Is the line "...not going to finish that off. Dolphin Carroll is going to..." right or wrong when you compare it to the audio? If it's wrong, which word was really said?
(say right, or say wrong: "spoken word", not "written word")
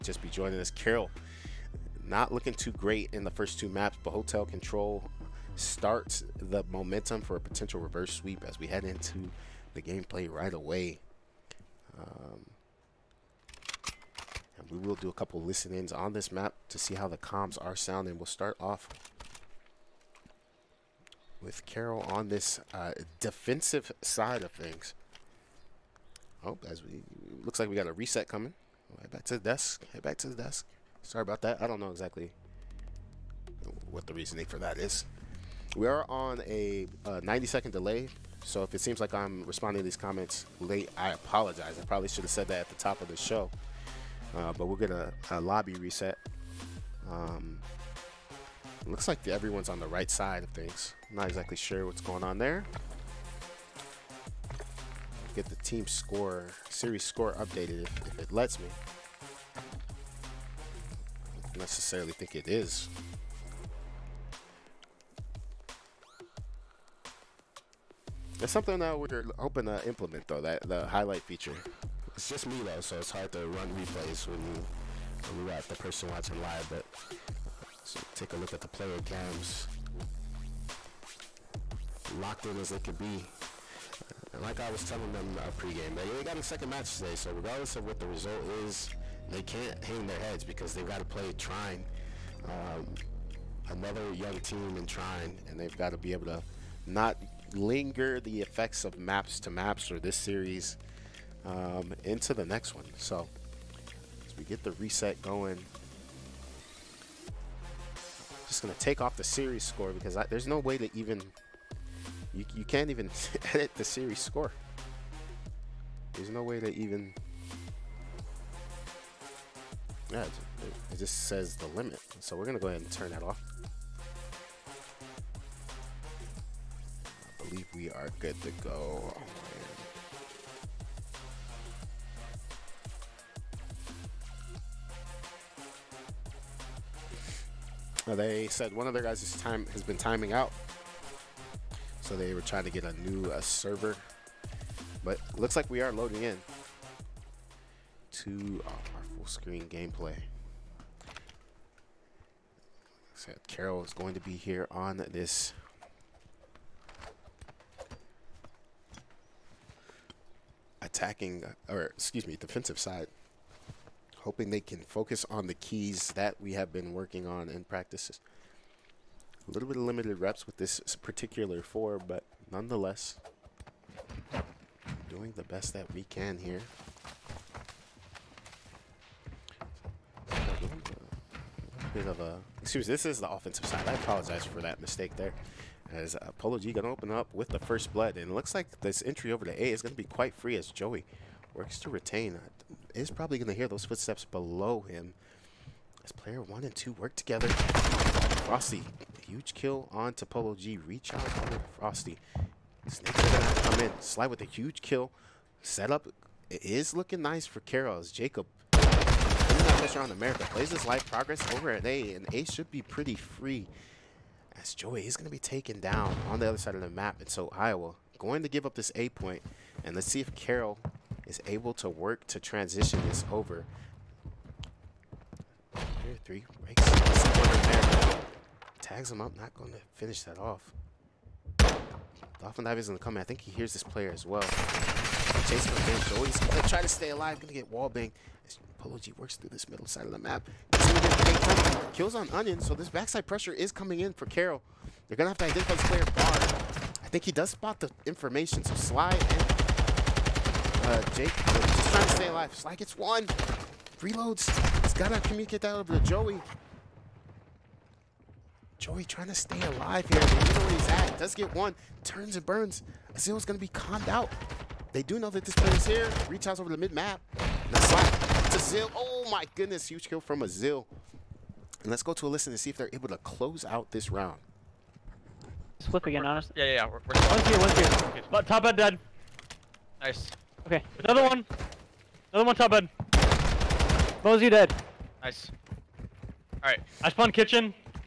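wrong: "Dive", not "Carroll".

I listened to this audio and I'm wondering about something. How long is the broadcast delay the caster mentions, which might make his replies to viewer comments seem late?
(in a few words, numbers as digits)
90 seconds.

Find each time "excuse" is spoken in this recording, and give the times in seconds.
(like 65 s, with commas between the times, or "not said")
161 s, 182 s.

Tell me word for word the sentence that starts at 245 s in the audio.
They're going to have to identify this player Bar.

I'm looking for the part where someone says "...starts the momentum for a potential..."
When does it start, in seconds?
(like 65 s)
5 s.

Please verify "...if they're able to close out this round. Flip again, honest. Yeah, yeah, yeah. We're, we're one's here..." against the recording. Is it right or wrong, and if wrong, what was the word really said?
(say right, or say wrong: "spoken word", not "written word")
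right.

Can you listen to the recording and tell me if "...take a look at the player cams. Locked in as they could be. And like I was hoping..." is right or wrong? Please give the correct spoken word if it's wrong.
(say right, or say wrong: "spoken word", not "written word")
wrong: "telling", not "hoping".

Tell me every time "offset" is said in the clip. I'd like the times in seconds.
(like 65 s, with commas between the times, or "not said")
not said.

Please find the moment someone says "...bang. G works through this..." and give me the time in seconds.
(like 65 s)
237 s.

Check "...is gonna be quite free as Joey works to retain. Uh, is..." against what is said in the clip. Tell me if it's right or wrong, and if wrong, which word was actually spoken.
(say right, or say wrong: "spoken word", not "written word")
right.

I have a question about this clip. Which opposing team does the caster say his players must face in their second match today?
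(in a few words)
Trine.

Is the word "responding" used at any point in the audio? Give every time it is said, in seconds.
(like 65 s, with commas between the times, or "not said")
39 s.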